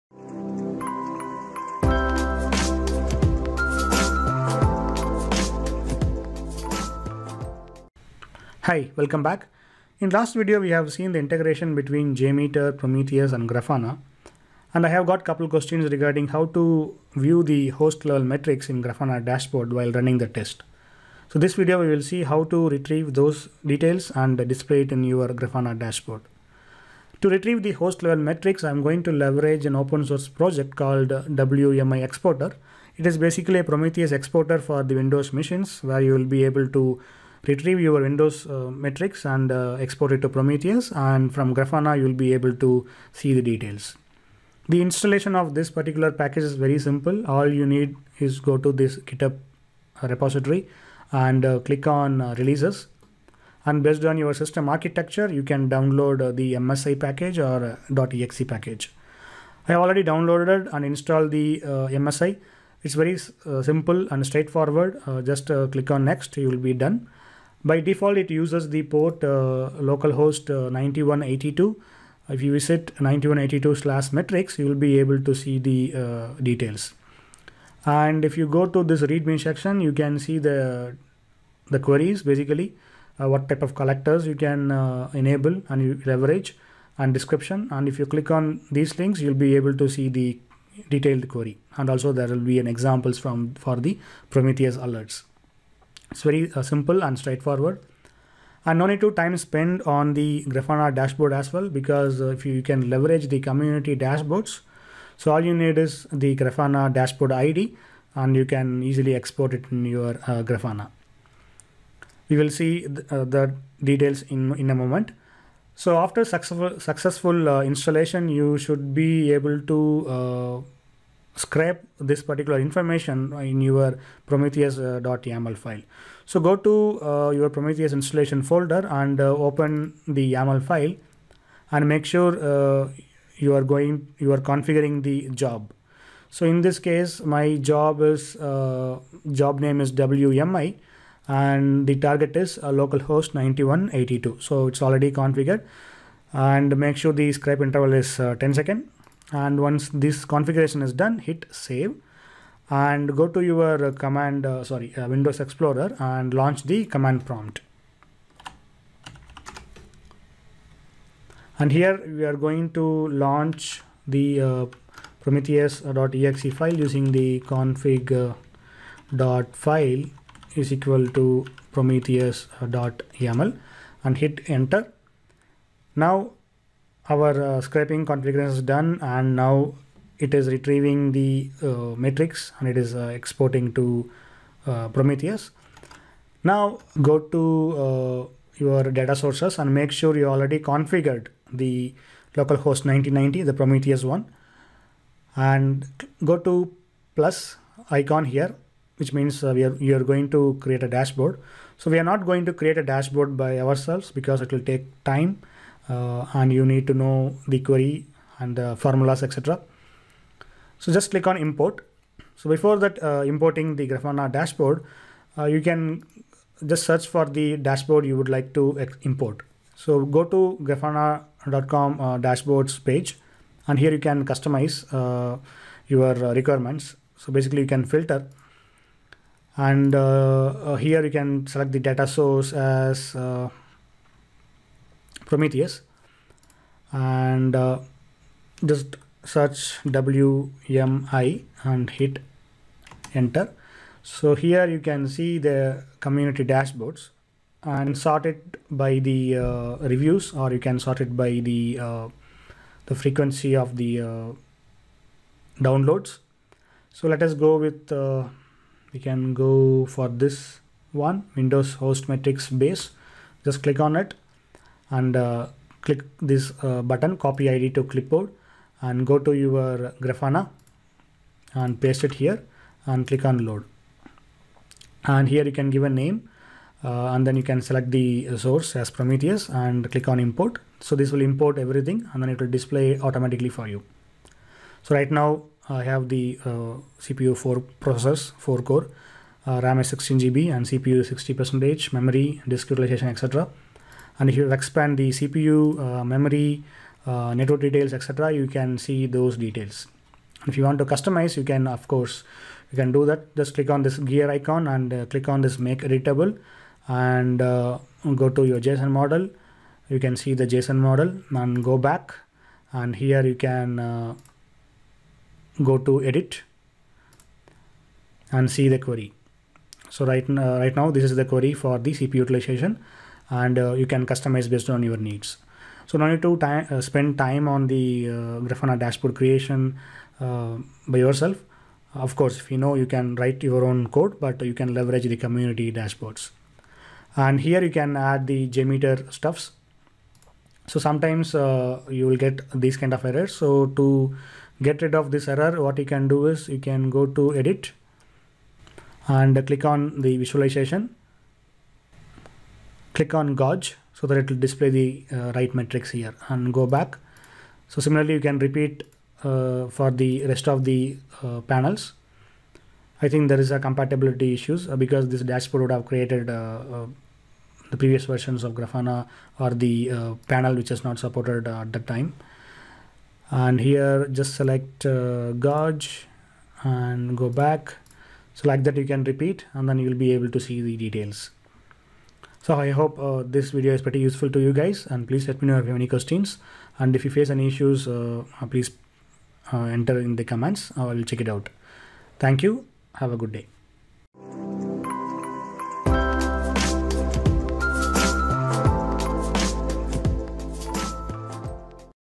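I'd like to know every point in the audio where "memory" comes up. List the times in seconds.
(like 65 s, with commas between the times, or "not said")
291 s, 296 s.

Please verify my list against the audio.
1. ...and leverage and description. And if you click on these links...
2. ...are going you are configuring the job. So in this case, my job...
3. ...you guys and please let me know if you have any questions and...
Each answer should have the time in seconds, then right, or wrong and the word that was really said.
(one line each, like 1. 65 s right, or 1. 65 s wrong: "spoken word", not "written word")
1. 85 s right
2. 133 s right
3. 384 s right.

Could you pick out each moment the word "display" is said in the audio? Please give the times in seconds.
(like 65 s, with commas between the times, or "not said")
24 s, 282 s, 354 s.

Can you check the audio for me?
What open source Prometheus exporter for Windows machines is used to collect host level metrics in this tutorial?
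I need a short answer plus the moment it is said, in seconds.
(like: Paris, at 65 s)
WMI Exporter, at 31 s.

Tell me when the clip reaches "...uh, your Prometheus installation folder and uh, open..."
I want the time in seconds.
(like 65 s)
127 s.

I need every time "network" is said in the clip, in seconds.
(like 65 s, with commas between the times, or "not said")
297 s.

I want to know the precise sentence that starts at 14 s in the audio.
And I have got couple questions regarding how to view the host level metrics in Grafana dashboard while running the test.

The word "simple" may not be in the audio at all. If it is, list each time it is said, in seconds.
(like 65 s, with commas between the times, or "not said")
46 s, 63 s, 96 s.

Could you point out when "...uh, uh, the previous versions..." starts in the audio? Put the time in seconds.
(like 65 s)
366 s.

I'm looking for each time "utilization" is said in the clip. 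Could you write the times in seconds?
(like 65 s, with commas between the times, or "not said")
292 s, 322 s.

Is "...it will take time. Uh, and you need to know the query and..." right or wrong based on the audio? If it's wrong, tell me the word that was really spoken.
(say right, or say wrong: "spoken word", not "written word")
right.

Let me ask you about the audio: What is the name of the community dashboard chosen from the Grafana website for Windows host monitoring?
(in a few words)
Windows host metrics base.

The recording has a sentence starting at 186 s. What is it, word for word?
Now go to your data sources and make sure you already configured the localhost 1990, the Prometheus one.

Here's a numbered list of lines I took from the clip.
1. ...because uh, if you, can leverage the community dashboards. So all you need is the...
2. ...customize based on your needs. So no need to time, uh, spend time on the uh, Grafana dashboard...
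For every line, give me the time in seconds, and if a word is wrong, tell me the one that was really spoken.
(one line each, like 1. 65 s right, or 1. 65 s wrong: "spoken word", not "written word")
1. 101 s right
2. 324 s right.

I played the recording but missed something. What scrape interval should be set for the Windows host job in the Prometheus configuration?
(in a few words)
10 seconds.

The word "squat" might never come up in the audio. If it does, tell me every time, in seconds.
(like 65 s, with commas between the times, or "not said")
not said.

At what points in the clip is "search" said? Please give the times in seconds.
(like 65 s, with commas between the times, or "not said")
216 s, 239 s.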